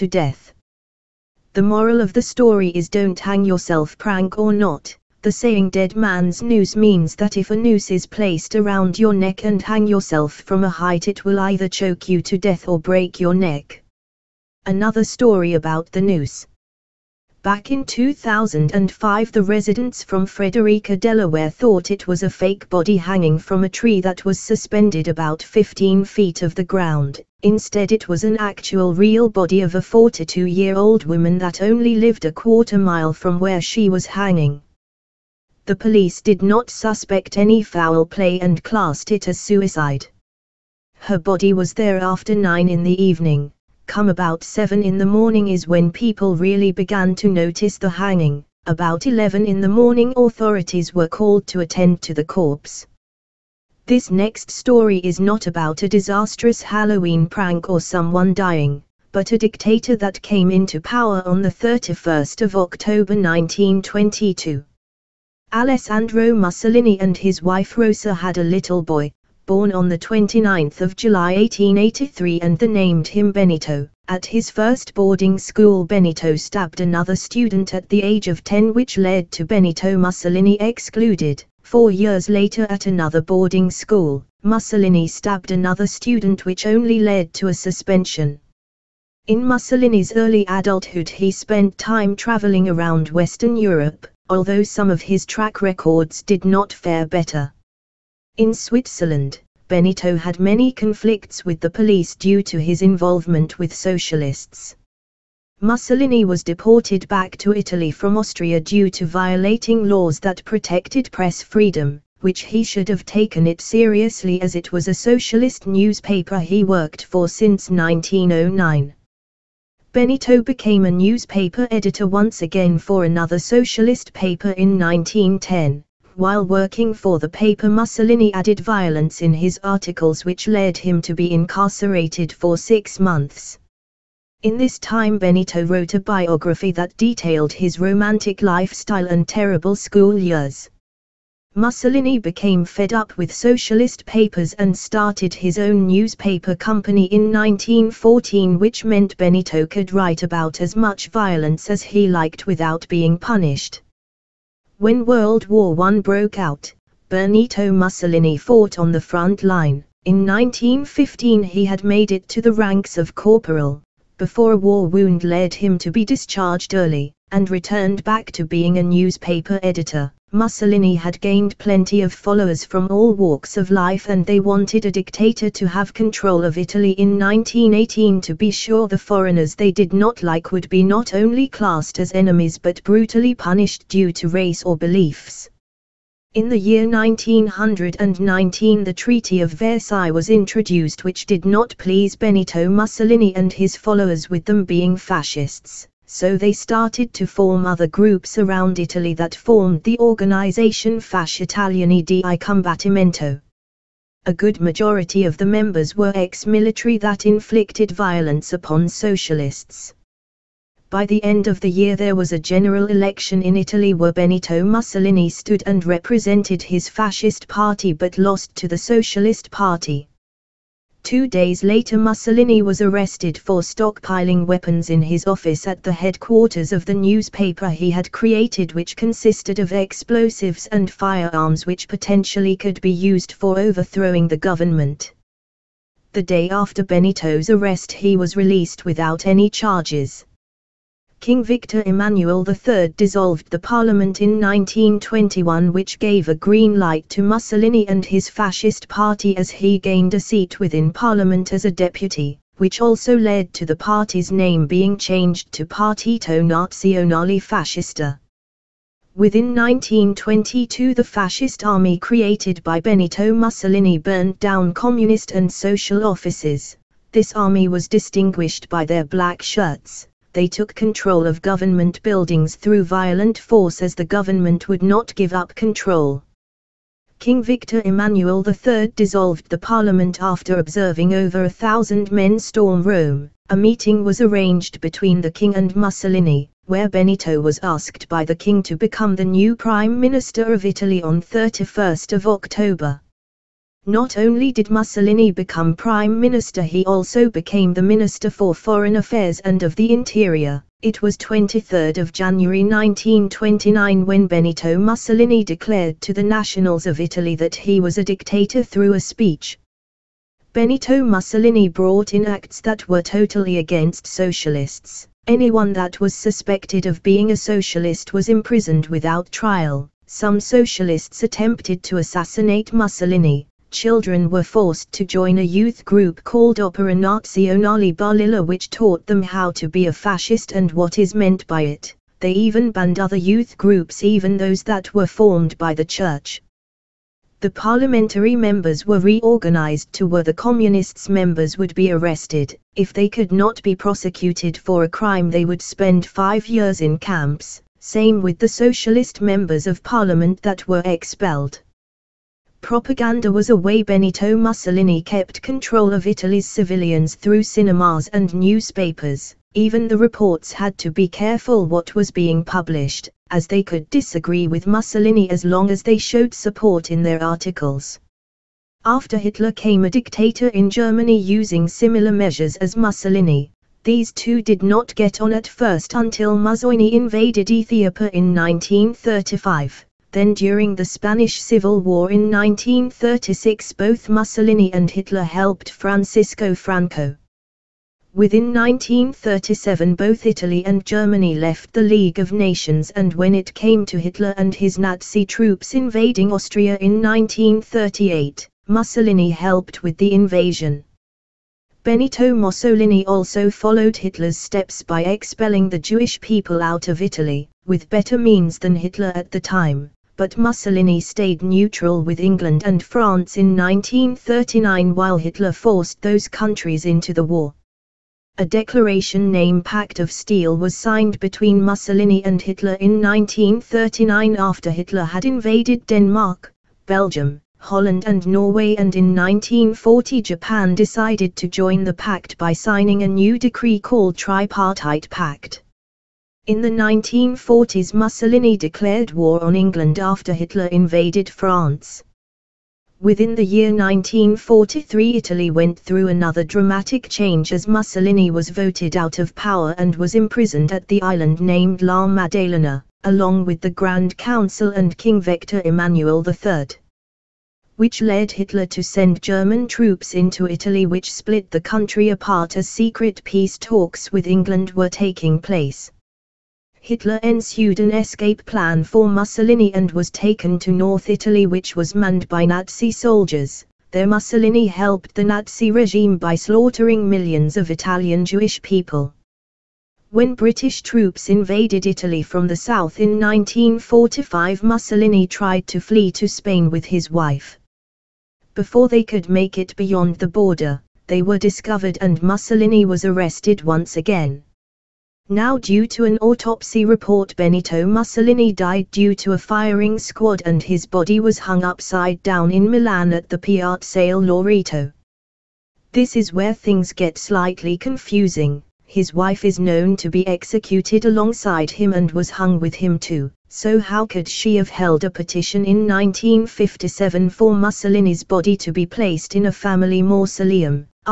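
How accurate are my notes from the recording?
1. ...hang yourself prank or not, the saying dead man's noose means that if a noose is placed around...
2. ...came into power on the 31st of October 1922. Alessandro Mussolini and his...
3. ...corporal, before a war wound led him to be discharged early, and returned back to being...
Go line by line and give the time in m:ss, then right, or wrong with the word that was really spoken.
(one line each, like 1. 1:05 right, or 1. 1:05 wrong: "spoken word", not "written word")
1. 0:03 right
2. 1:00 right
3. 2:43 right.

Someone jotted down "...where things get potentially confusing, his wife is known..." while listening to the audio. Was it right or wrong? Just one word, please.
wrong.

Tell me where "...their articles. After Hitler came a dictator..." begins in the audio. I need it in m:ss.
6:07.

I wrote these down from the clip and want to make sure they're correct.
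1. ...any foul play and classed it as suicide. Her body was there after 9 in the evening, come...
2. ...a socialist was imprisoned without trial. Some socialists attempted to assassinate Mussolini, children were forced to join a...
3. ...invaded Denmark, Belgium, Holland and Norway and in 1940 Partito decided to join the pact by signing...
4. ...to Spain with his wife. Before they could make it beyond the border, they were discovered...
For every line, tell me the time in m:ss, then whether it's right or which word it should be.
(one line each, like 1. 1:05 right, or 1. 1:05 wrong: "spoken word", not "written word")
1. 0:37 right
2. 5:17 right
3. 7:05 wrong: "Japan", not "Partito"
4. 8:06 right.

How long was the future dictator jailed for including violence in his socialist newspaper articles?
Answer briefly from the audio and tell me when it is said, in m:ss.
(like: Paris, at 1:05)
six months, at 2:12.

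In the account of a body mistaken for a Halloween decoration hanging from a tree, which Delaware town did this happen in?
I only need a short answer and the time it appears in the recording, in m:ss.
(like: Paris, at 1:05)
Frederica, at 0:20.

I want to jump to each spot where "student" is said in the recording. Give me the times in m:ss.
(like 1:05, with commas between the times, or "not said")
1:17, 1:25.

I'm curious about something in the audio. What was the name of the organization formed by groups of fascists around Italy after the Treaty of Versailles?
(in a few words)
Fasci Italiani di Combattimento.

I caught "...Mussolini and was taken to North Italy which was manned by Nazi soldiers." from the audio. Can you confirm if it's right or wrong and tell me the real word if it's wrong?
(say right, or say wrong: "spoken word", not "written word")
right.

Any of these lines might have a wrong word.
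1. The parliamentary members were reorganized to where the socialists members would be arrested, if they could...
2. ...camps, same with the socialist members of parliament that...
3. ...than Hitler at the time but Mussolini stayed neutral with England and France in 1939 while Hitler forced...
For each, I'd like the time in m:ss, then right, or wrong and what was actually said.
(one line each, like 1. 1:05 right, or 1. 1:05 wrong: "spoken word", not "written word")
1. 5:37 wrong: "communists", not "socialists"
2. 5:46 right
3. 6:48 right.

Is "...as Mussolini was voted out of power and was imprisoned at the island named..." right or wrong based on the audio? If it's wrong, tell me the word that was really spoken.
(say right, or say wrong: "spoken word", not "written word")
right.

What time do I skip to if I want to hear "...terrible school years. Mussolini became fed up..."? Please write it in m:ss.
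2:19.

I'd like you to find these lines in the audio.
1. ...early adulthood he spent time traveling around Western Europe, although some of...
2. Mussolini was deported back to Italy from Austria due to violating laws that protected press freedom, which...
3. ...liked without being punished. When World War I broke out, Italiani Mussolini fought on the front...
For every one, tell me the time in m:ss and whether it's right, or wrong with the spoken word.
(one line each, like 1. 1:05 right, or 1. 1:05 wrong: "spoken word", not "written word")
1. 1:30 right
2. 1:45 right
3. 2:32 wrong: "Benito", not "Italiani".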